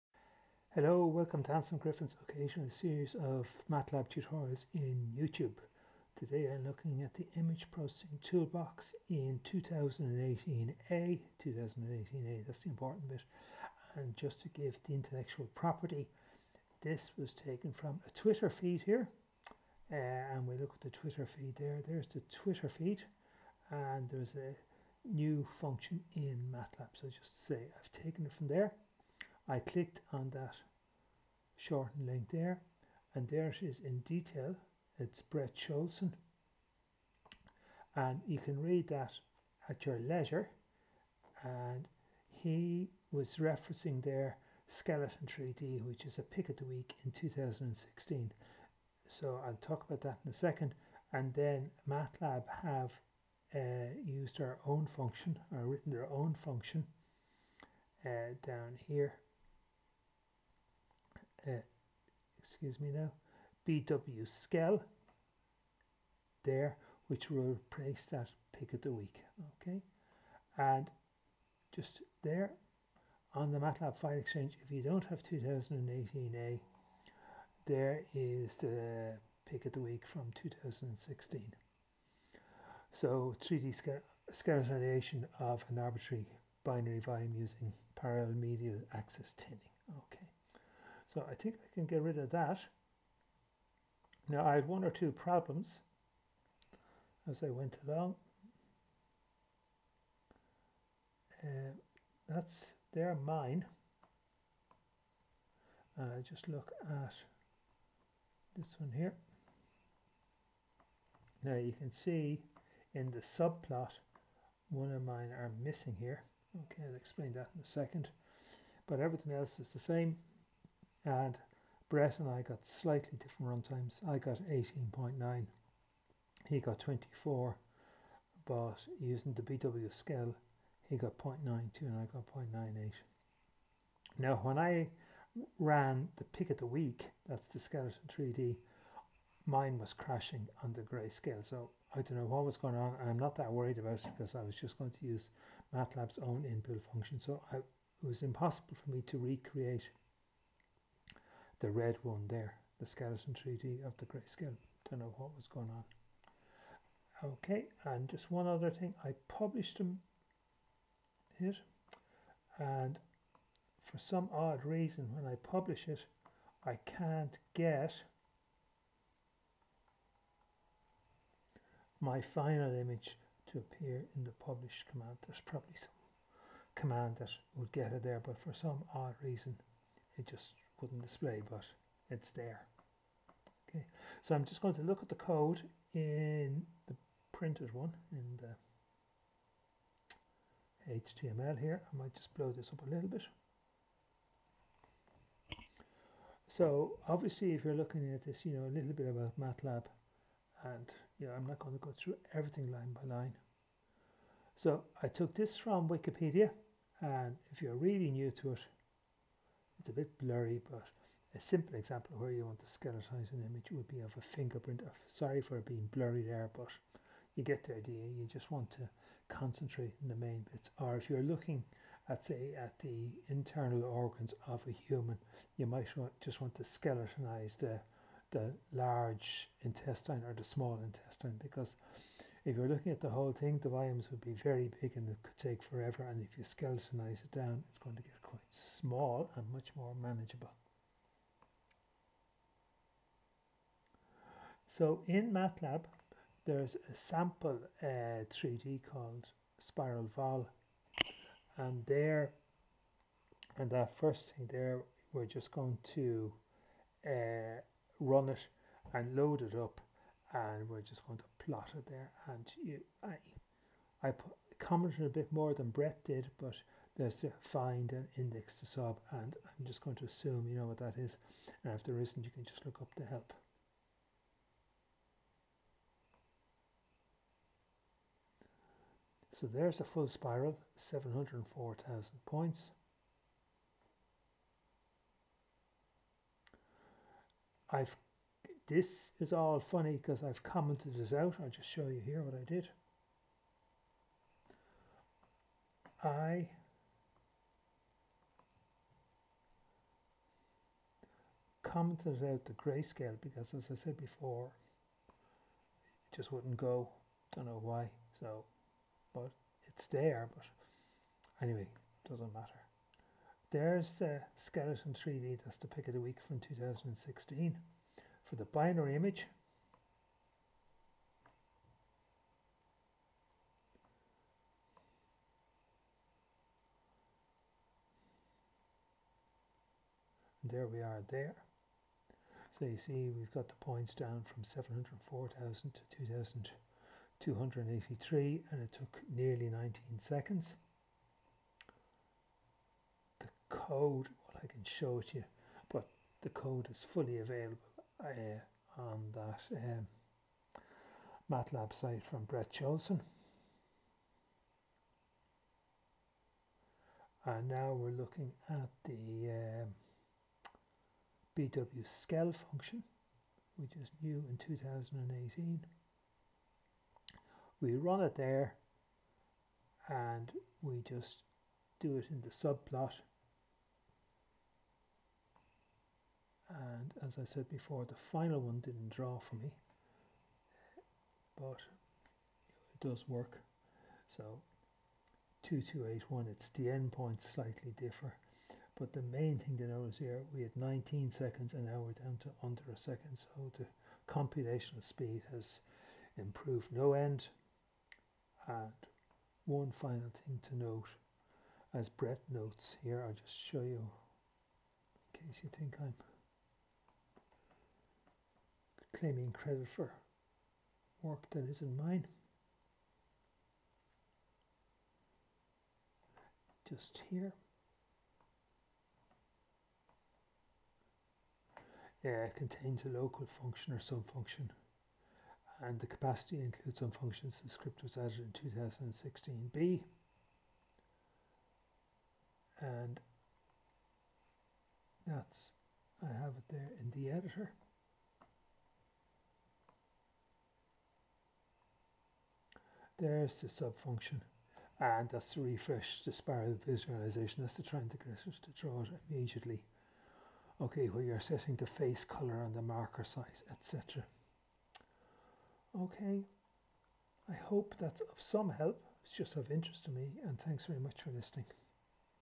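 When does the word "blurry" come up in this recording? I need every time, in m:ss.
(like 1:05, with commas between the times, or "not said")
3:30, 3:35.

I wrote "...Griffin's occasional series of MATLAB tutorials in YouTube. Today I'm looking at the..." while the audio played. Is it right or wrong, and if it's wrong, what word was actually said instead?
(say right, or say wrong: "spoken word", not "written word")
right.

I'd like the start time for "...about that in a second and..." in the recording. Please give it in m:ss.
0:49.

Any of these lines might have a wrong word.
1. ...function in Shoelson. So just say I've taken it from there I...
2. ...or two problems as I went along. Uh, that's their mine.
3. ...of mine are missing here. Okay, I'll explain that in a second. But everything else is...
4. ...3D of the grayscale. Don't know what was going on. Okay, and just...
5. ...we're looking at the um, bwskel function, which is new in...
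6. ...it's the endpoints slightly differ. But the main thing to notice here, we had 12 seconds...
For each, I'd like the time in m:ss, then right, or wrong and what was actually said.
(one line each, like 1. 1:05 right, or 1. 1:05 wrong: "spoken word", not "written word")
1. 0:25 wrong: "MATLAB", not "Shoelson"
2. 1:34 right
3. 1:54 right
4. 2:33 right
5. 5:57 right
6. 6:26 wrong: "19", not "12".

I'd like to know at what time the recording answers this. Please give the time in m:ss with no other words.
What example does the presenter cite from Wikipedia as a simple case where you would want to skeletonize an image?
3:34.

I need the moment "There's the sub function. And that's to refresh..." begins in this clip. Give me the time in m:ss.
7:23.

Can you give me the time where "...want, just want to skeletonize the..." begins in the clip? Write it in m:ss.
3:45.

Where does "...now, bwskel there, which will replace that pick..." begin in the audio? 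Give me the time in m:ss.
1:02.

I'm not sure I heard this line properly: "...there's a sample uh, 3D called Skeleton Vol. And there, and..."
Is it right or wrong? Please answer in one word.
wrong.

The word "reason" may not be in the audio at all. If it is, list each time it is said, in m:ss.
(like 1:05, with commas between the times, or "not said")
2:44, 2:59.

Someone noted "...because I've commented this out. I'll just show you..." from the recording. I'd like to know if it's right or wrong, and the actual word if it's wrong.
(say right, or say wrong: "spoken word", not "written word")
right.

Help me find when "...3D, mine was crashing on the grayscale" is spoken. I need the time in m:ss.
2:18.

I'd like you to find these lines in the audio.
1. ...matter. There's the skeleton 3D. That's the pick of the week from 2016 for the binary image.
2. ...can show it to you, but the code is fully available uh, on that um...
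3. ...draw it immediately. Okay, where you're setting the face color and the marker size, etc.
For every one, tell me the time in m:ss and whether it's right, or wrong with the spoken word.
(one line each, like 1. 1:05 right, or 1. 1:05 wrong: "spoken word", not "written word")
1. 5:12 right
2. 5:44 right
3. 7:28 right.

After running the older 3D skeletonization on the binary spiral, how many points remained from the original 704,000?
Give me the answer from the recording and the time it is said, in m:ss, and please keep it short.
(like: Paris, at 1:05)
2,283, at 5:35.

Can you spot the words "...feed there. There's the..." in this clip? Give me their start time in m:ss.
0:21.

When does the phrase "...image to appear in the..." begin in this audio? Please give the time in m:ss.
2:52.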